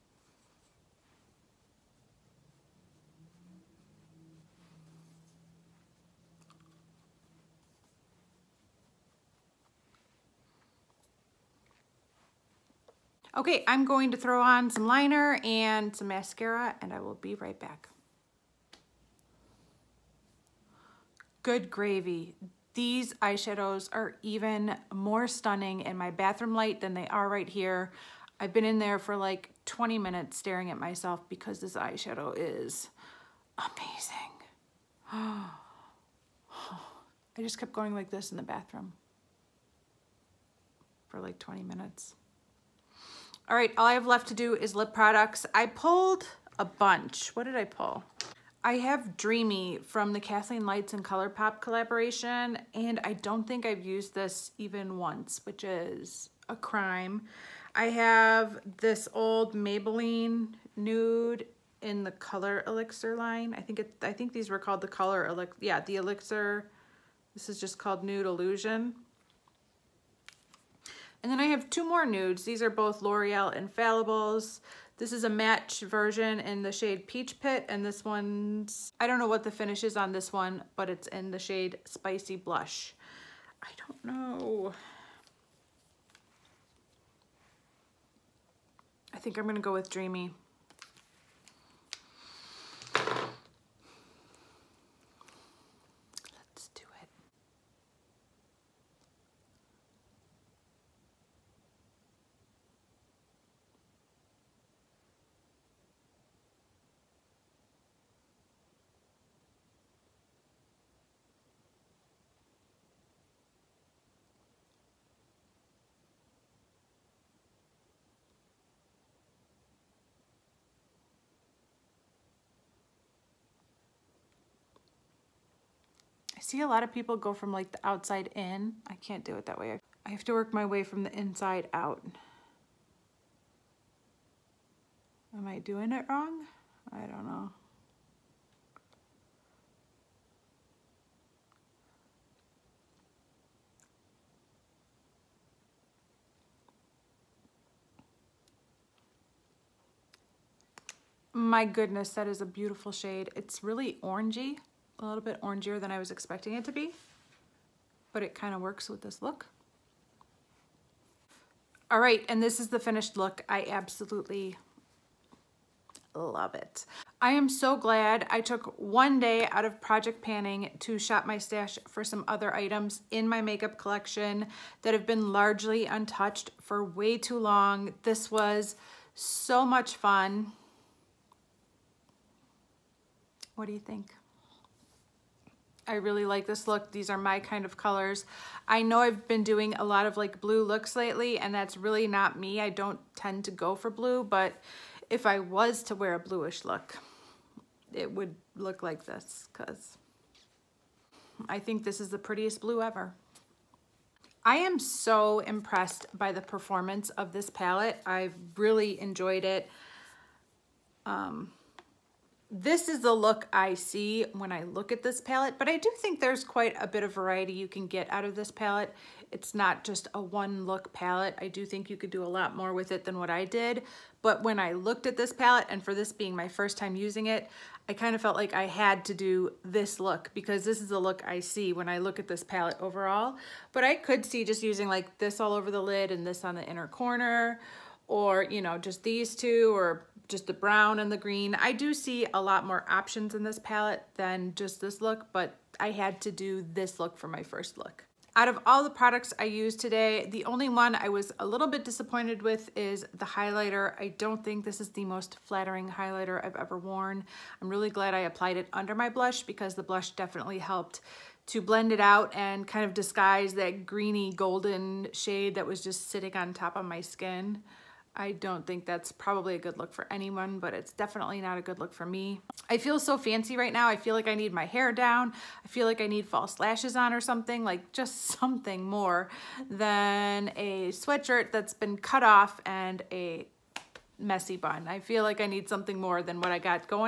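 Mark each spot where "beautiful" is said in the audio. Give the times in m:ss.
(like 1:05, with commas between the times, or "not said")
2:32.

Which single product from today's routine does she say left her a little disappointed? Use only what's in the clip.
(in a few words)
The highlighter.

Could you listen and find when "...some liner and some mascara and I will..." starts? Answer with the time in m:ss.
0:14.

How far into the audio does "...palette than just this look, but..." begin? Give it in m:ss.
4:03.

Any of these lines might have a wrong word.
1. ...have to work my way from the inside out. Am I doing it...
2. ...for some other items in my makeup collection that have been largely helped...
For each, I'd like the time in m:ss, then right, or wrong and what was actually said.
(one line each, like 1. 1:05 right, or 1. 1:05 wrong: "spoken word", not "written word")
1. 2:10 right
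2. 2:51 wrong: "untouched", not "helped".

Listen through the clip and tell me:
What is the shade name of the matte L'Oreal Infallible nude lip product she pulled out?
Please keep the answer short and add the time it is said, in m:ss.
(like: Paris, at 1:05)
Peach Pit, at 1:17.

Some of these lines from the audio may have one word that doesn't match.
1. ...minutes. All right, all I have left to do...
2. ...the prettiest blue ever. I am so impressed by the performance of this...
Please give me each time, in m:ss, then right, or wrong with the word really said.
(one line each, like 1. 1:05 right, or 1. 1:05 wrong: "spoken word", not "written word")
1. 0:41 right
2. 3:22 right.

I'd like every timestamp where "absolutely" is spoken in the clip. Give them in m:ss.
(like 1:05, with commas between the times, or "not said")
2:43.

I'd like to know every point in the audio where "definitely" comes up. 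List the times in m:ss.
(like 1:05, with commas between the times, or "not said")
4:20, 4:30.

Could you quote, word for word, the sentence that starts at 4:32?
I feel so fancy right now.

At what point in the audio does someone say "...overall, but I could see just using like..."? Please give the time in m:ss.
3:52.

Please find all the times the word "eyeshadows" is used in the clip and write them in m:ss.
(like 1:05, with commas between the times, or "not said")
0:23, 0:31.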